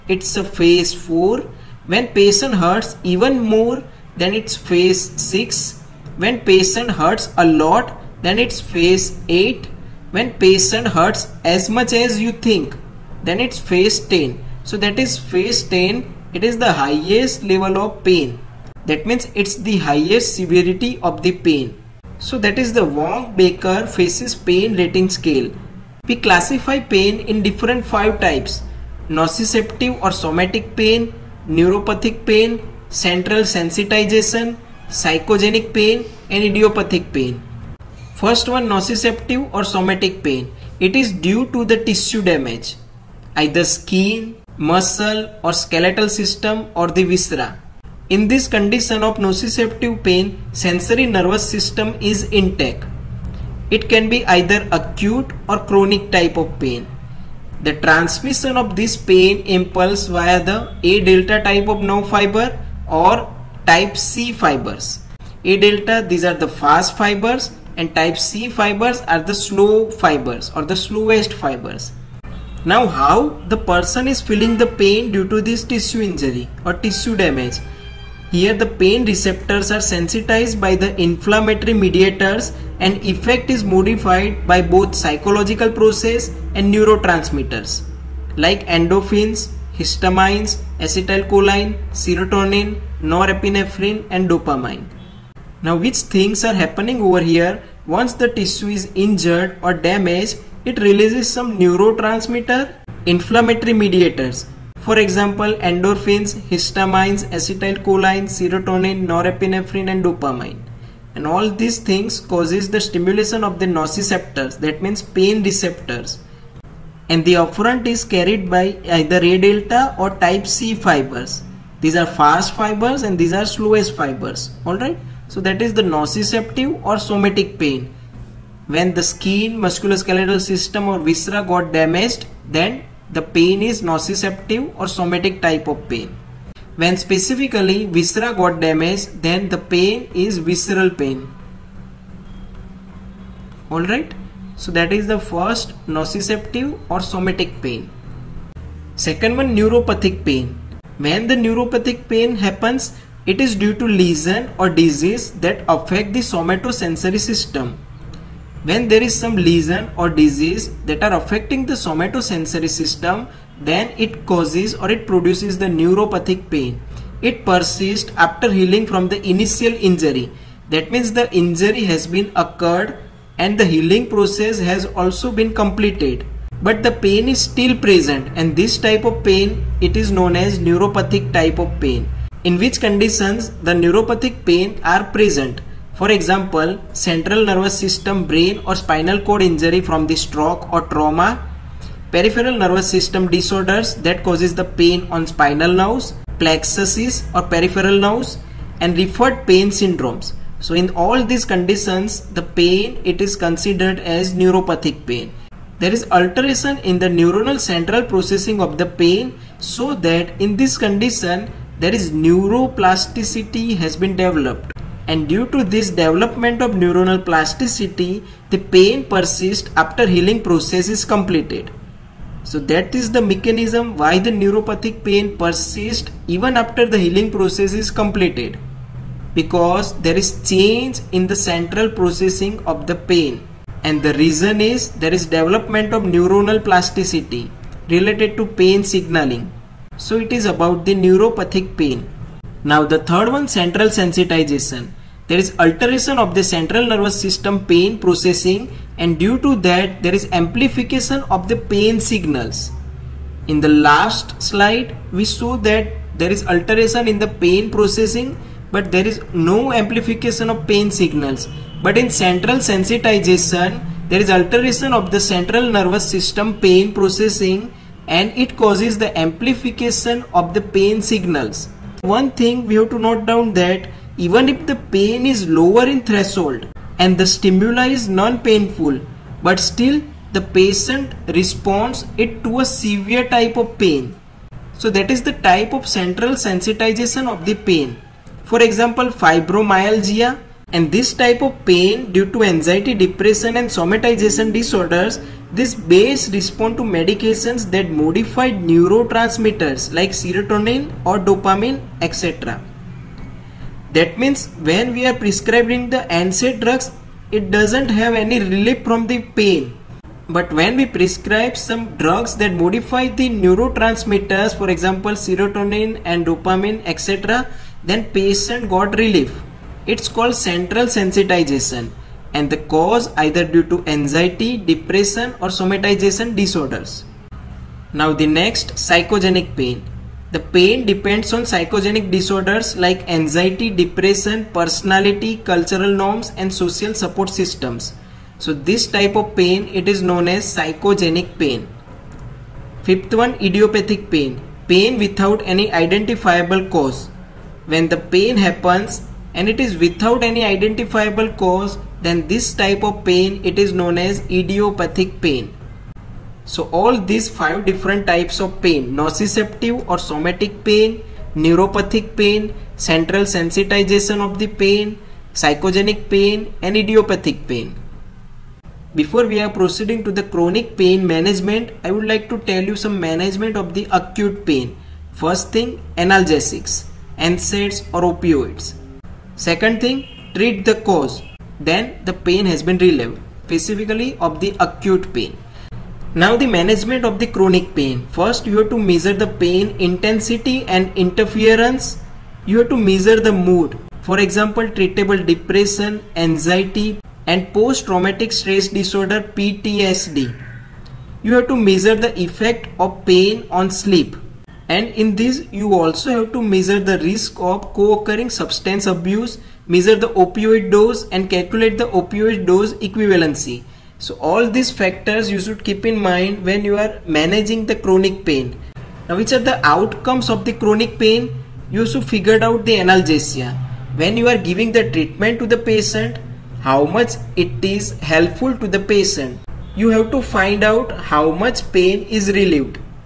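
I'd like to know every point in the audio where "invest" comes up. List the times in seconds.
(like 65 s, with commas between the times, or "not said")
not said.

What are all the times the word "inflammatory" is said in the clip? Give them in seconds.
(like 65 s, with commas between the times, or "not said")
81 s, 103 s.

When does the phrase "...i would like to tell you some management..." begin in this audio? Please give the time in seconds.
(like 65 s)
371 s.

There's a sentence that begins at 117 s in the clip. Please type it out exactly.
And the afferent is carried by either A delta or type C fibers.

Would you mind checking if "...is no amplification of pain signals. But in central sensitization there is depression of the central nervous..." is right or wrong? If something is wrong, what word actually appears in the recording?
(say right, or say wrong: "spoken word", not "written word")
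wrong: "alteration", not "depression".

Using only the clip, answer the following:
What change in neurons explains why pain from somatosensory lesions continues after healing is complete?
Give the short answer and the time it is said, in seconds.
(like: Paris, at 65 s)
Neuroplasticity, at 212 s.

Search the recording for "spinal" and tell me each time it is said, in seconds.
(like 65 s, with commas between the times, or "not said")
188 s, 195 s.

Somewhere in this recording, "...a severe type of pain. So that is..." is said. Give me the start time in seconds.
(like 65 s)
282 s.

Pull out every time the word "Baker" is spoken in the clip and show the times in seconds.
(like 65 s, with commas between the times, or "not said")
23 s.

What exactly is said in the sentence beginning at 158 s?
When there is some lesion or disease that are affecting the somatosensory system, then it causes or it produces the neuropathic pain.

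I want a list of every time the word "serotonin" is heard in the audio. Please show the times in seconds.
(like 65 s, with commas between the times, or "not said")
91 s, 108 s, 300 s, 315 s.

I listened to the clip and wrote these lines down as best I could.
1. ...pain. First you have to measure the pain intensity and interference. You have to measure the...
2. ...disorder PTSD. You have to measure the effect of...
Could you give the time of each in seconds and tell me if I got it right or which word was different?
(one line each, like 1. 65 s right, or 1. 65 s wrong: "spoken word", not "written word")
1. 387 s right
2. 398 s right.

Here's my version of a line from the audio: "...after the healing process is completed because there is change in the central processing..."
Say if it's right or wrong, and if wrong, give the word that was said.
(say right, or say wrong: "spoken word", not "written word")
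right.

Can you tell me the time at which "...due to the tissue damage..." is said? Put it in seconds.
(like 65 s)
41 s.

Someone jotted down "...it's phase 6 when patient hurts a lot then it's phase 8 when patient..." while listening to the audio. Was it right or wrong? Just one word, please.
right.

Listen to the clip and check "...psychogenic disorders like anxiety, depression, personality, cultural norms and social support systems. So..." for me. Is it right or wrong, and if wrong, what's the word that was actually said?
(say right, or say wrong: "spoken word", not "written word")
right.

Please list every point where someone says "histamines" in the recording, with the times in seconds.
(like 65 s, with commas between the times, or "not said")
89 s, 106 s.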